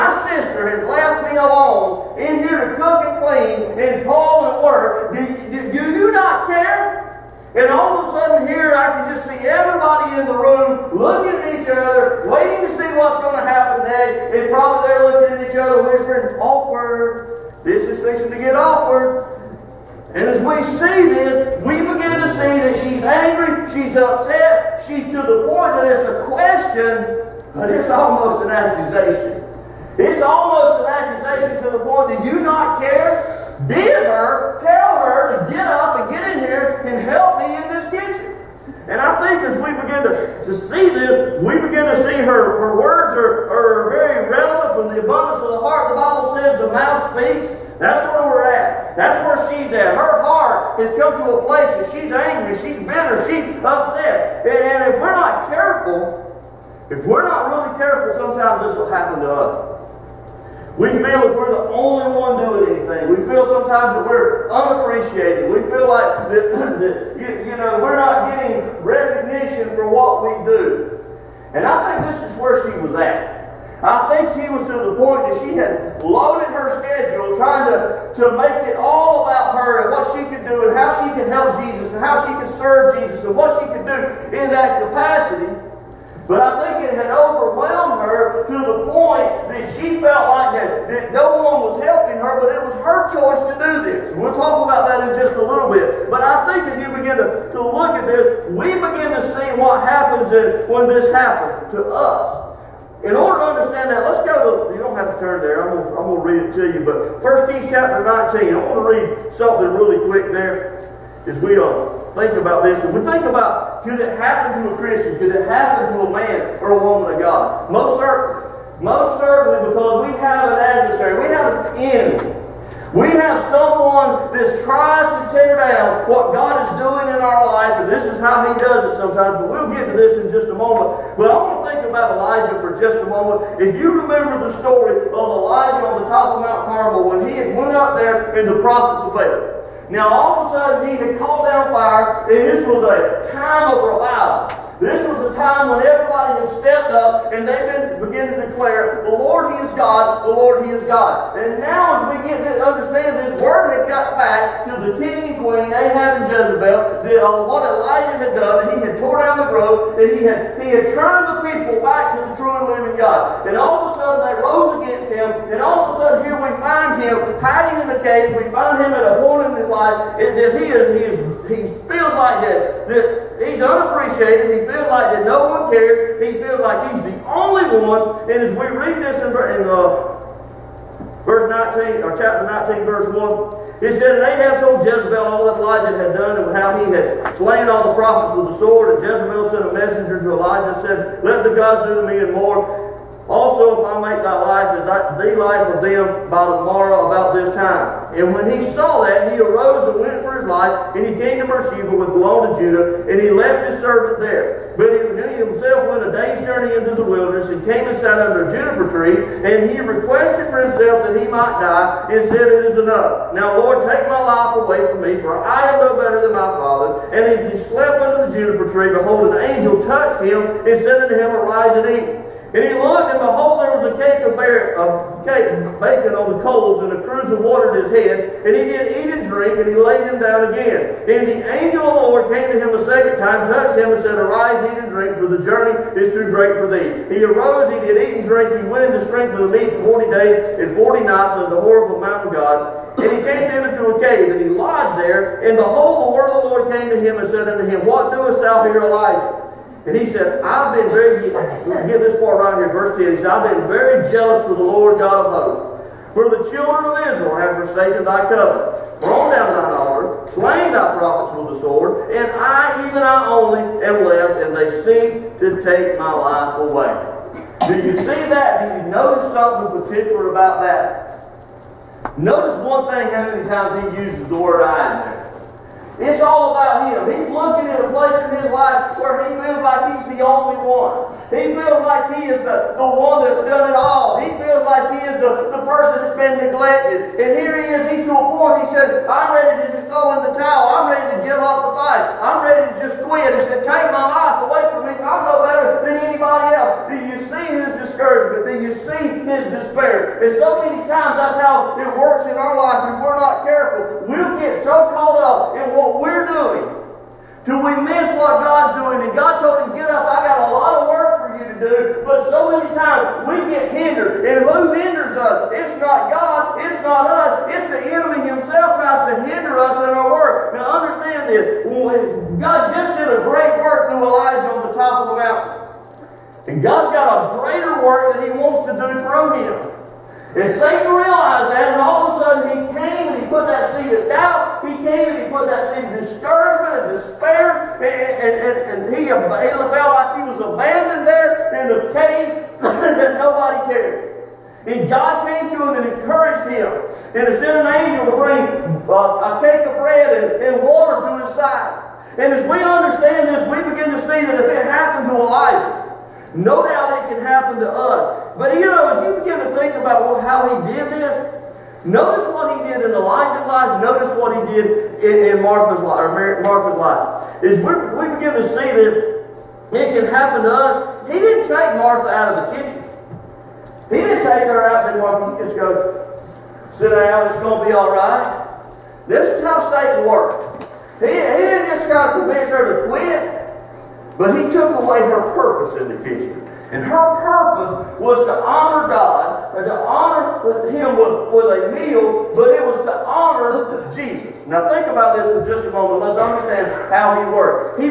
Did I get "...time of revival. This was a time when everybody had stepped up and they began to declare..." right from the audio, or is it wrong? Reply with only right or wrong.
right.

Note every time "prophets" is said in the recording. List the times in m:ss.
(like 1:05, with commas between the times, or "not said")
2:18, 3:07, 4:20.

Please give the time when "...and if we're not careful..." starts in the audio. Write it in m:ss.
0:54.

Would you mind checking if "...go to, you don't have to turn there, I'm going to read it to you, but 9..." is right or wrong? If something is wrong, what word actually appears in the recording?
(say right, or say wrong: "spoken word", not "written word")
wrong: "1", not "9".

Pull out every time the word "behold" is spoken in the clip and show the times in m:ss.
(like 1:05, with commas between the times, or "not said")
3:38, 3:43, 4:05.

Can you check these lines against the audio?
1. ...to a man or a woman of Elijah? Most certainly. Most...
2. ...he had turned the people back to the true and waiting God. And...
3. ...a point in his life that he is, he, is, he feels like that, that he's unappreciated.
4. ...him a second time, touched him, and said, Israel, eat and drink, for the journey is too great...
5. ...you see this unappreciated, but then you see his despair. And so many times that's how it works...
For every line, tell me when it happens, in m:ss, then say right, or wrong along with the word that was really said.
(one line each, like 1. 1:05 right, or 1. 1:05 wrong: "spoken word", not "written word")
1. 1:55 wrong: "God", not "Elijah"
2. 2:40 wrong: "living", not "waiting"
3. 2:49 right
4. 3:52 wrong: "Arise", not "Israel"
5. 4:56 wrong: "discouraged", not "unappreciated".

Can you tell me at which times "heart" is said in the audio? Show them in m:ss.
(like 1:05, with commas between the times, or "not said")
0:45, 0:50.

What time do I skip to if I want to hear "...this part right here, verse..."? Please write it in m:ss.
4:12.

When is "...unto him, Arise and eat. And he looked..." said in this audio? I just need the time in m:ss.
3:41.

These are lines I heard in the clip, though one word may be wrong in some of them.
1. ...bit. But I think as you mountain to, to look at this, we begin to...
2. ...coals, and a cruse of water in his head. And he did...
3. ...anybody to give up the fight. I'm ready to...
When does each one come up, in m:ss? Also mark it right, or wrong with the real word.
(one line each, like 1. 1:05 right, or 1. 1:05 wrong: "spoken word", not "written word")
1. 1:35 wrong: "begin", not "mountain"
2. 3:46 right
3. 4:50 wrong: "ready", not "anybody".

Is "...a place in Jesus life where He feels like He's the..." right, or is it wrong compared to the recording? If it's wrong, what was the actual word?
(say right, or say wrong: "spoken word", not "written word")
wrong: "His", not "Jesus".